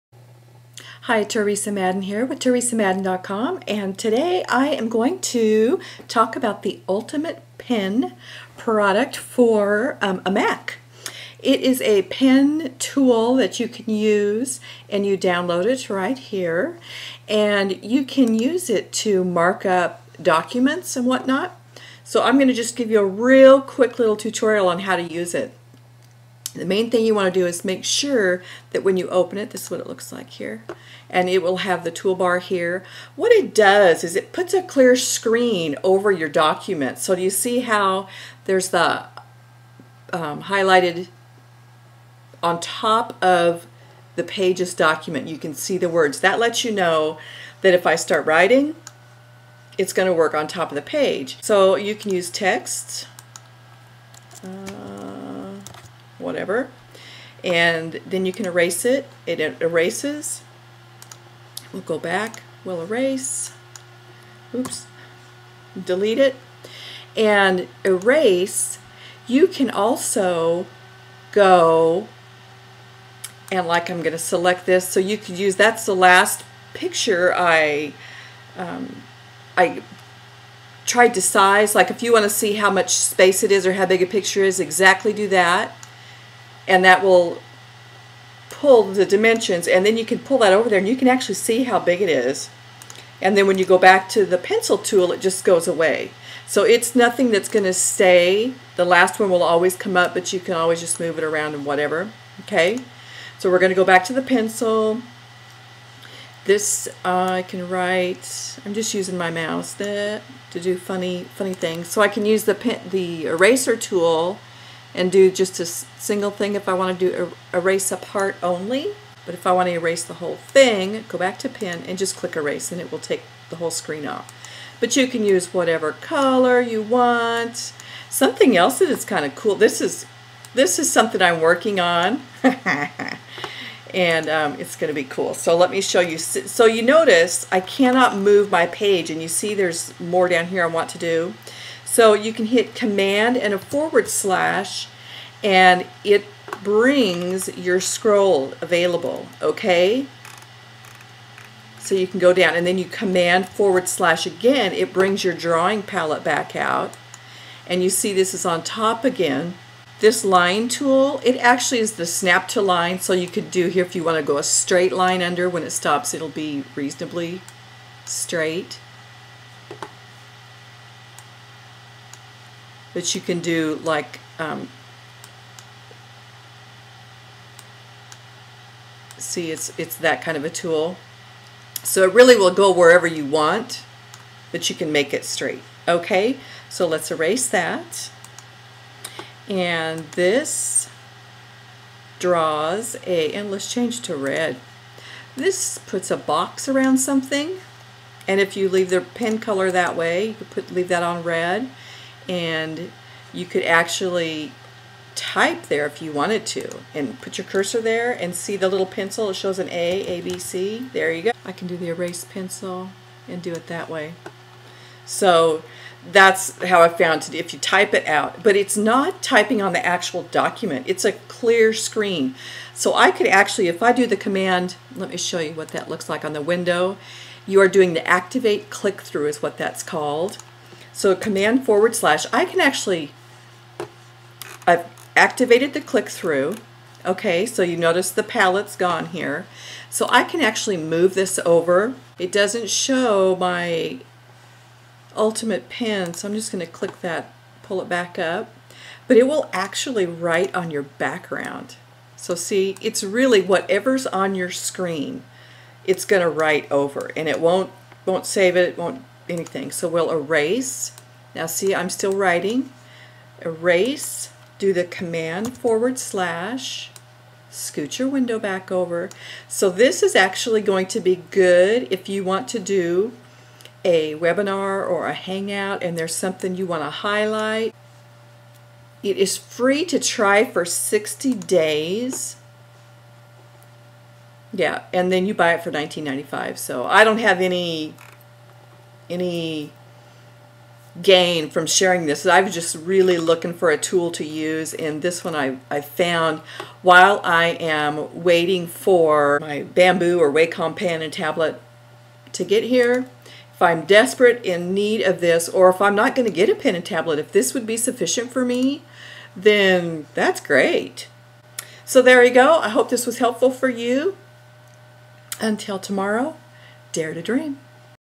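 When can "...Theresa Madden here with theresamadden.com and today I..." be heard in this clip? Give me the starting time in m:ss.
0:01.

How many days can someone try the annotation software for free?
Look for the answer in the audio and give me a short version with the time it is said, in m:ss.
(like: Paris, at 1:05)
60, at 4:40.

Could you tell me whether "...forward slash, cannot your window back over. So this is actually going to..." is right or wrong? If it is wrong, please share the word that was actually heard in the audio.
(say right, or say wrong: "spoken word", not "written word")
wrong: "scoot", not "cannot".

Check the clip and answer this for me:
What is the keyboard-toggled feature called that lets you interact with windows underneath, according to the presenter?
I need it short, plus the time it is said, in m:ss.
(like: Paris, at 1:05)
activate click-through, at 3:48.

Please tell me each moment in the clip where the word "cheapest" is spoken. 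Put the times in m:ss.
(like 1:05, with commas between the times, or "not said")
not said.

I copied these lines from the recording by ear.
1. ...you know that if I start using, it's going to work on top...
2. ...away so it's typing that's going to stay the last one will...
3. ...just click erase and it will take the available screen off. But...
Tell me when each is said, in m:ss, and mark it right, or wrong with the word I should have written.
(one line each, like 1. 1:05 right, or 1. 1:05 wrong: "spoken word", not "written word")
1. 0:46 wrong: "writing", not "using"
2. 1:35 wrong: "nothing", not "typing"
3. 2:01 wrong: "whole", not "available".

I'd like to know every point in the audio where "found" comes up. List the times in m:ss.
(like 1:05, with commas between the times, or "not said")
3:36, 4:55.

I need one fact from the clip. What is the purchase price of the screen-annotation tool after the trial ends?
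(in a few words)
19.95.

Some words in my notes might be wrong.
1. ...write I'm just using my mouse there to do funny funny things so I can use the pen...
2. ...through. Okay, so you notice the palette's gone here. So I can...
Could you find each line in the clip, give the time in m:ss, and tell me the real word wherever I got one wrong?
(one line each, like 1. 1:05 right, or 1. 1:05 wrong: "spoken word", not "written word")
1. 1:47 right
2. 3:56 right.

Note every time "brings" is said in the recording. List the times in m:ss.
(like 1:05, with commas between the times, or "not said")
2:26, 2:34.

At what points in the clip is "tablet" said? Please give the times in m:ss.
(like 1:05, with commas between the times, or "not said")
5:01, 5:06.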